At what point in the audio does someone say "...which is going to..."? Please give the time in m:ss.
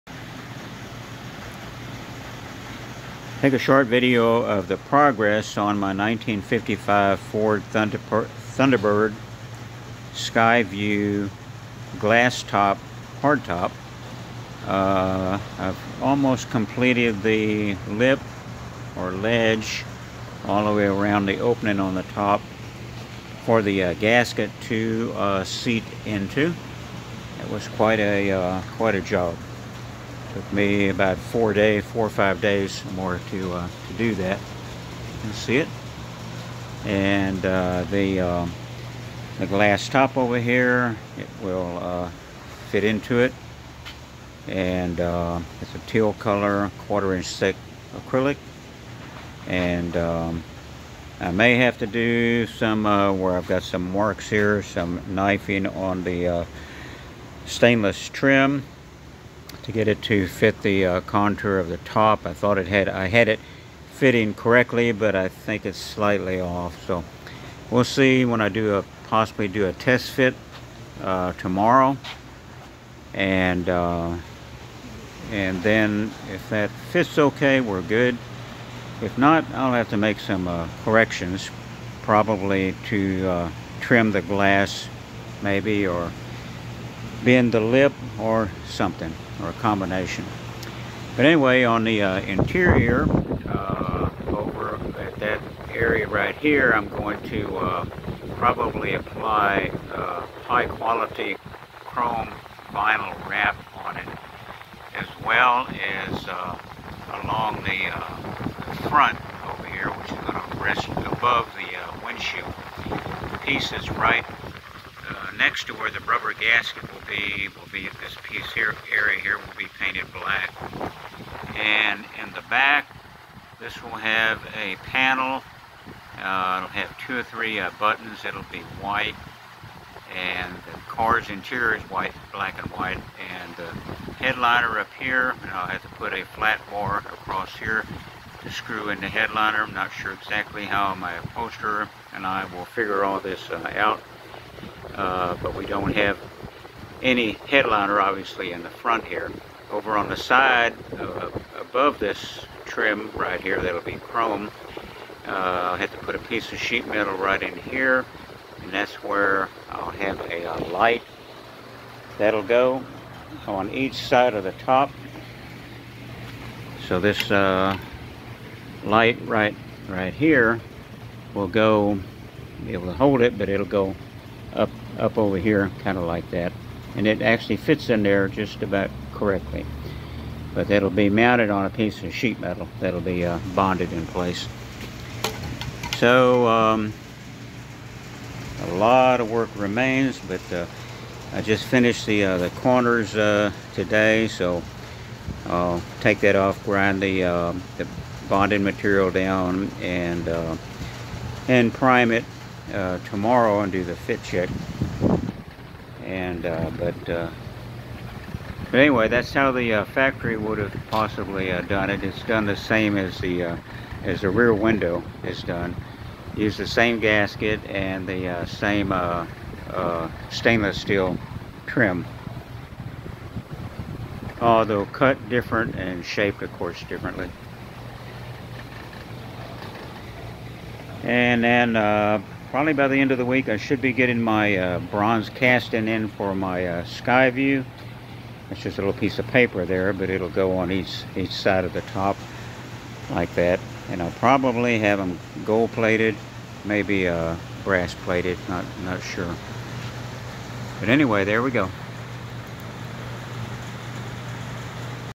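1:49.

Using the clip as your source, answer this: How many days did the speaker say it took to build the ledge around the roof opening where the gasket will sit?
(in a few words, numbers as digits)
4 or 5 days.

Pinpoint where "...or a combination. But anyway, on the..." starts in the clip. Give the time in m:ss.
1:29.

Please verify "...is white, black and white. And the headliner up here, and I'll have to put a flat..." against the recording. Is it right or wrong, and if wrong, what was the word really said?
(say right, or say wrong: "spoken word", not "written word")
right.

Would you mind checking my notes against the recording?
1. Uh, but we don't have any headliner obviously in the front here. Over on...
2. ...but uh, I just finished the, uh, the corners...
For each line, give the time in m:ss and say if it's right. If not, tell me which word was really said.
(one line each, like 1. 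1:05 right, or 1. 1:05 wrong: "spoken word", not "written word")
1. 2:24 right
2. 3:10 right.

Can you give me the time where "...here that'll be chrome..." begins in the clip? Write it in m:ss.
2:33.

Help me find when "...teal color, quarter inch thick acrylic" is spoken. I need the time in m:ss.
0:45.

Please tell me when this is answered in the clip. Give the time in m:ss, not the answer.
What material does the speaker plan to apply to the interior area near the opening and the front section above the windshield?
1:41.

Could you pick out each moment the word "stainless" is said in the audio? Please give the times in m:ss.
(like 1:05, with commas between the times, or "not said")
0:57, 3:40.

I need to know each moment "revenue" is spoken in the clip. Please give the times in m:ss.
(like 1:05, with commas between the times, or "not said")
not said.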